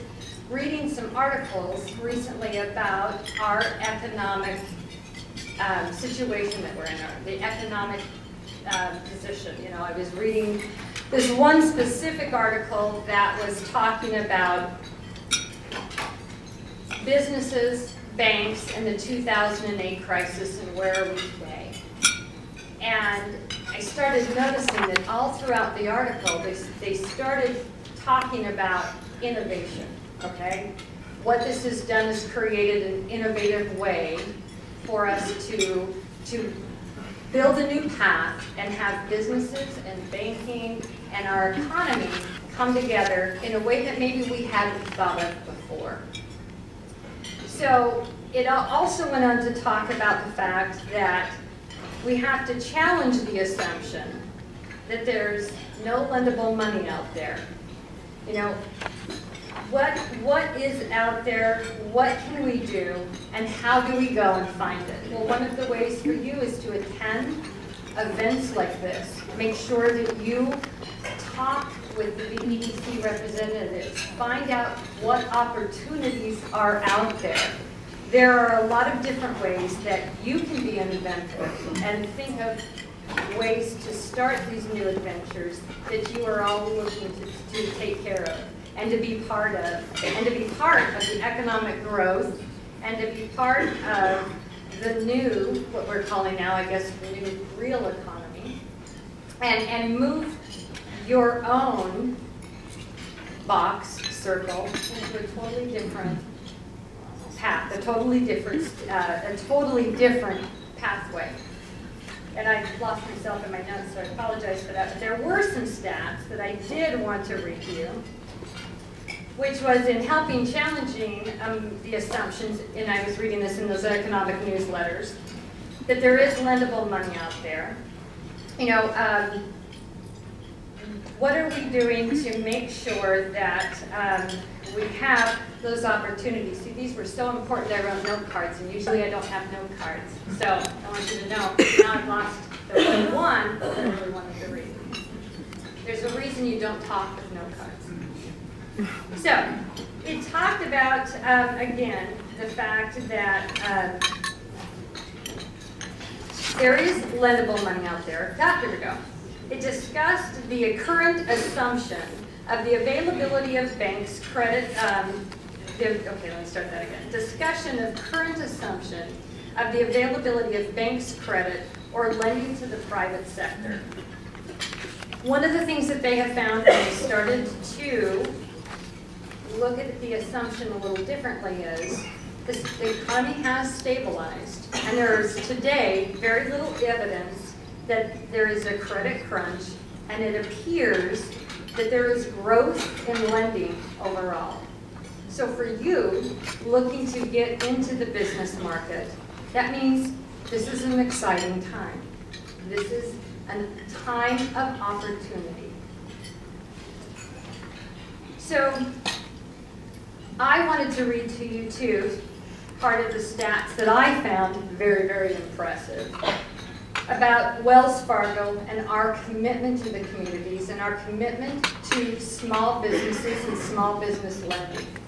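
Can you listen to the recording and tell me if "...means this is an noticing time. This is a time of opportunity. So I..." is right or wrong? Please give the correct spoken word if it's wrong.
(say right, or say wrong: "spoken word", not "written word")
wrong: "exciting", not "noticing".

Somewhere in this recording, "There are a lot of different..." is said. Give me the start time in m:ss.
1:18.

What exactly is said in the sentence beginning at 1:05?
Well, one of the ways for you is to attend events like this.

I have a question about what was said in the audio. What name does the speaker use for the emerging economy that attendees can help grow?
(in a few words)
the new real economy.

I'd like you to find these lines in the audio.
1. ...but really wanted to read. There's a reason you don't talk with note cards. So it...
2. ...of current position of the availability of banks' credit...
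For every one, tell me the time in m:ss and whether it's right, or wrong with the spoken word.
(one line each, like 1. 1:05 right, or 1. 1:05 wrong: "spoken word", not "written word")
1. 2:23 right
2. 2:47 wrong: "assumption", not "position".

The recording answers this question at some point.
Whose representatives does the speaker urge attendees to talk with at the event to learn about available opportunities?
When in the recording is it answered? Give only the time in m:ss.
1:12.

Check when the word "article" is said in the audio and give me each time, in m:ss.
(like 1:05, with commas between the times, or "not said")
0:01, 0:12, 0:25.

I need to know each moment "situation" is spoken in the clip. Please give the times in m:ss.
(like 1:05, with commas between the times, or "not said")
0:05.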